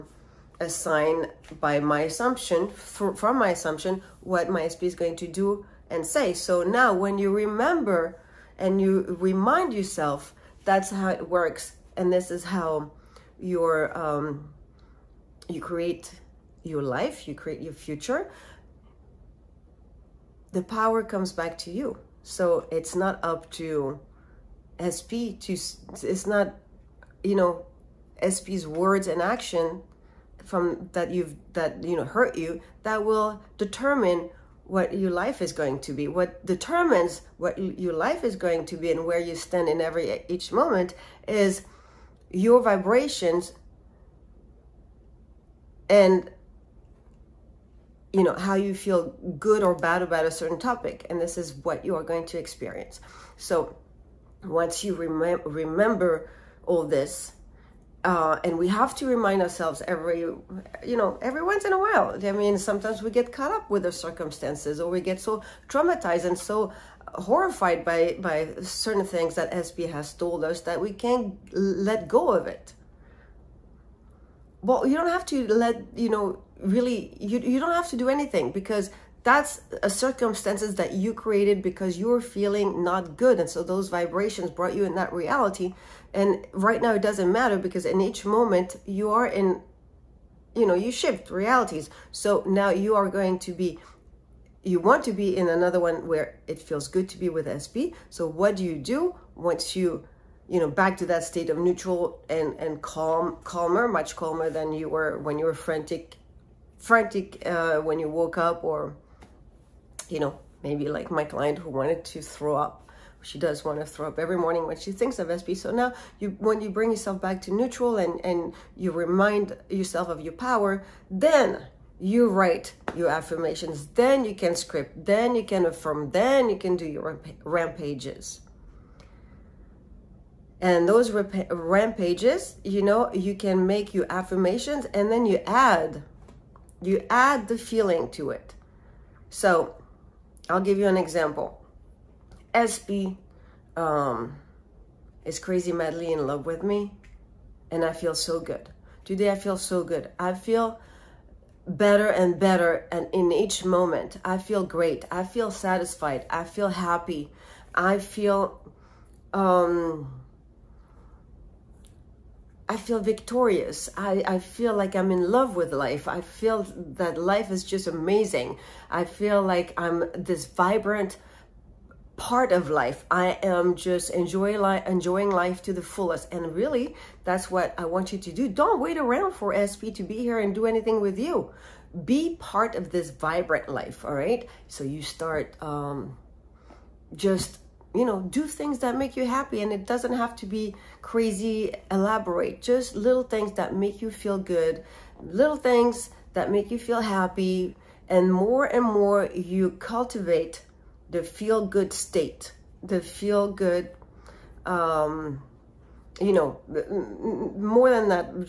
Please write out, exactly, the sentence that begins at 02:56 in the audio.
And really, that's what I want you to do.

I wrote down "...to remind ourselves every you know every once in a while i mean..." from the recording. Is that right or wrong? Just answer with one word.
right.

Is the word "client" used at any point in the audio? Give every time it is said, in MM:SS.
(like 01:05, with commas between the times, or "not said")
01:51.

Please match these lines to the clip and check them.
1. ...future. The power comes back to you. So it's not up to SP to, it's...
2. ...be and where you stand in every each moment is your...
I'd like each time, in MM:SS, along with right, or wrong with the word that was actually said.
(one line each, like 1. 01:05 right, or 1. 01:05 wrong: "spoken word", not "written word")
1. 00:17 right
2. 00:38 right.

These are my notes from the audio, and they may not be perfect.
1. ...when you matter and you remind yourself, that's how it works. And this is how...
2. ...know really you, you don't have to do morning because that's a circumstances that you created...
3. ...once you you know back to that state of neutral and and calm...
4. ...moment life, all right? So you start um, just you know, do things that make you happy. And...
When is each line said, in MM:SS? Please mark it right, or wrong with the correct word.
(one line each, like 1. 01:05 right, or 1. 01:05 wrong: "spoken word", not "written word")
1. 00:06 wrong: "remember", not "matter"
2. 01:16 wrong: "anything", not "morning"
3. 01:39 right
4. 03:03 wrong: "vibrant", not "moment".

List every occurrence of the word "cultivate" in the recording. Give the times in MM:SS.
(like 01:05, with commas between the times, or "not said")
03:19.